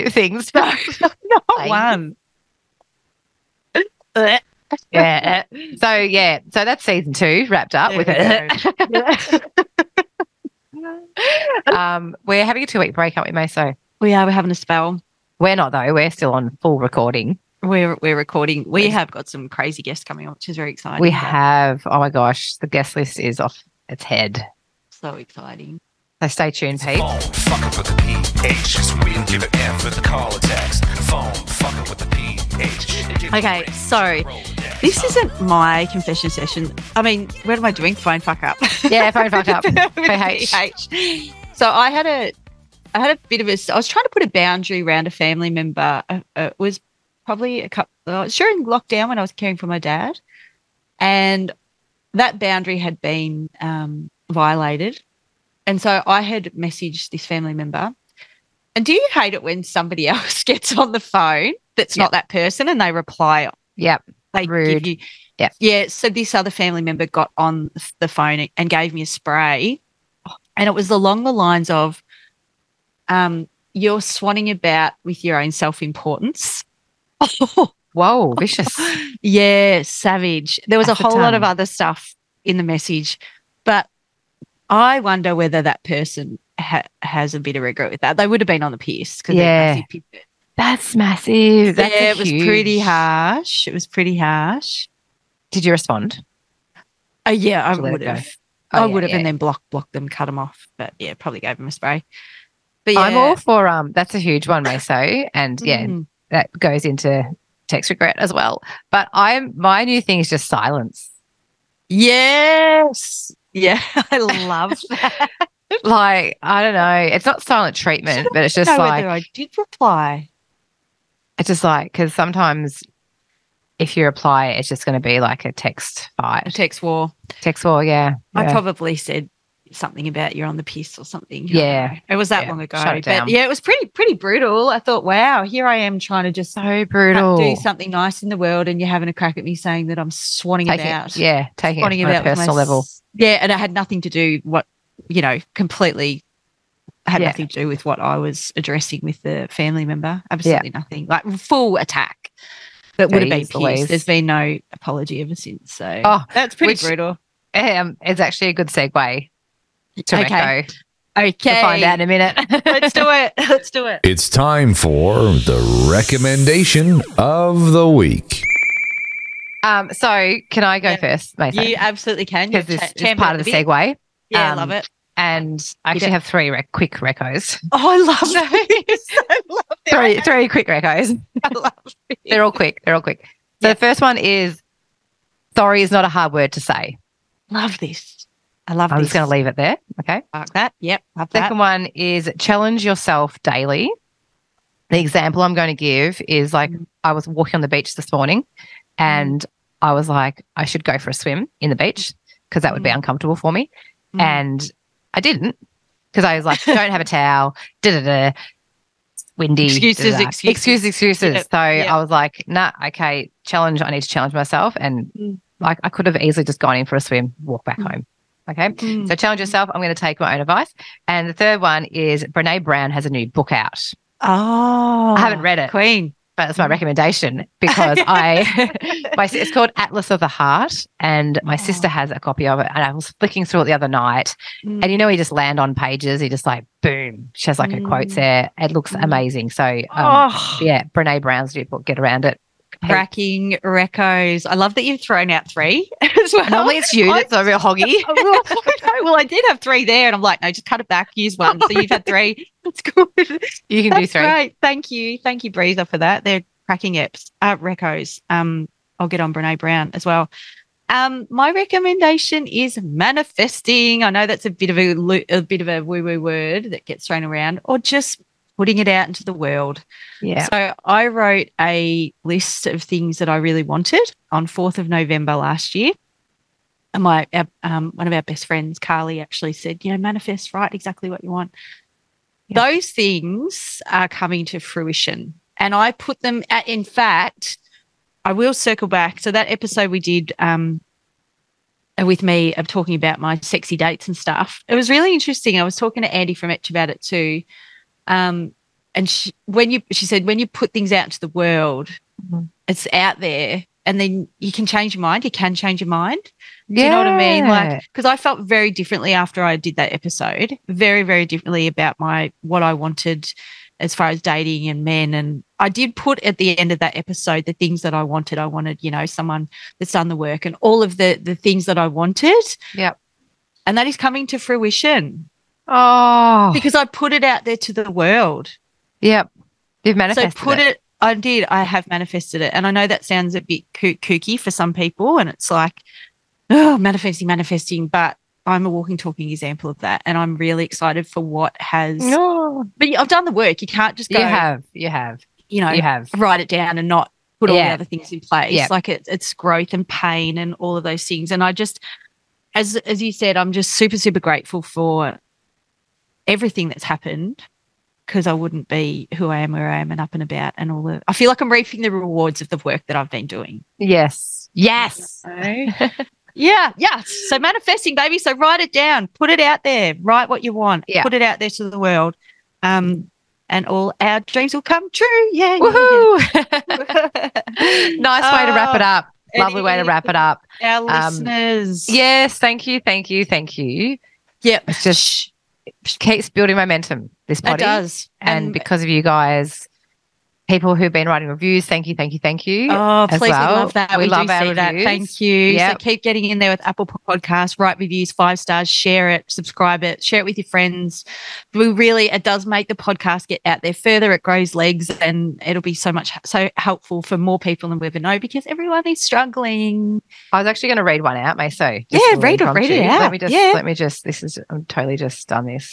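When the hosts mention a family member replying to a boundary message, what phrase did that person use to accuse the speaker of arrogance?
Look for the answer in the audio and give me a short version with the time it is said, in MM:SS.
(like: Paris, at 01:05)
swanning about with your own self importance, at 01:13.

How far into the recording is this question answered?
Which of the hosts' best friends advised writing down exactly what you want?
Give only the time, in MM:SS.
04:38.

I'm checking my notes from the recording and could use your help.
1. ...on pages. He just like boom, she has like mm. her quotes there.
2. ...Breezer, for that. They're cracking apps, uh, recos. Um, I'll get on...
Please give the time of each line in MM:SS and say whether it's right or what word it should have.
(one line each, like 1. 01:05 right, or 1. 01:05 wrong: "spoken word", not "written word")
1. 03:55 right
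2. 04:15 right.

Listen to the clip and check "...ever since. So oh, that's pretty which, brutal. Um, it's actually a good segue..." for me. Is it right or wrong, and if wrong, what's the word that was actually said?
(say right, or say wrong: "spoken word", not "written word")
right.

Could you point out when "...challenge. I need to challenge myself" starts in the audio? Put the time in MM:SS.
03:33.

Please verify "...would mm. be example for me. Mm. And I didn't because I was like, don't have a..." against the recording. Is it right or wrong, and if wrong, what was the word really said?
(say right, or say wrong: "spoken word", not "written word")
wrong: "uncomfortable", not "example".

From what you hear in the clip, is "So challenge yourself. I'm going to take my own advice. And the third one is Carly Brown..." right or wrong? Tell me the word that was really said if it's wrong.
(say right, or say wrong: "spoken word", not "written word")
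wrong: "Brene", not "Carly".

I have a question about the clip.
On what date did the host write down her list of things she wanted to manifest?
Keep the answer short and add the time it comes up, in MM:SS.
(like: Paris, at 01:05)
4th of November, at 04:34.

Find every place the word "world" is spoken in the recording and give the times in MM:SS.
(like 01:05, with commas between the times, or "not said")
02:18, 04:29, 05:01, 05:27, 06:11.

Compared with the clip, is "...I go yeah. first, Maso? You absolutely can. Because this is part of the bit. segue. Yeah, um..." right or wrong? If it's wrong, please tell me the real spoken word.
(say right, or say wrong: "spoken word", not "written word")
right.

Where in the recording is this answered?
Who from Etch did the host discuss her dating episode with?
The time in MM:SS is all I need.
04:56.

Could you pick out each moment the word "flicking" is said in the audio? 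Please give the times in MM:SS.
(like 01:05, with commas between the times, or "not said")
03:53.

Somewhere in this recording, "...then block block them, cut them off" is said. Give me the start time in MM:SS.
01:39.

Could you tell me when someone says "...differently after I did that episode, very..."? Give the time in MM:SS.
05:08.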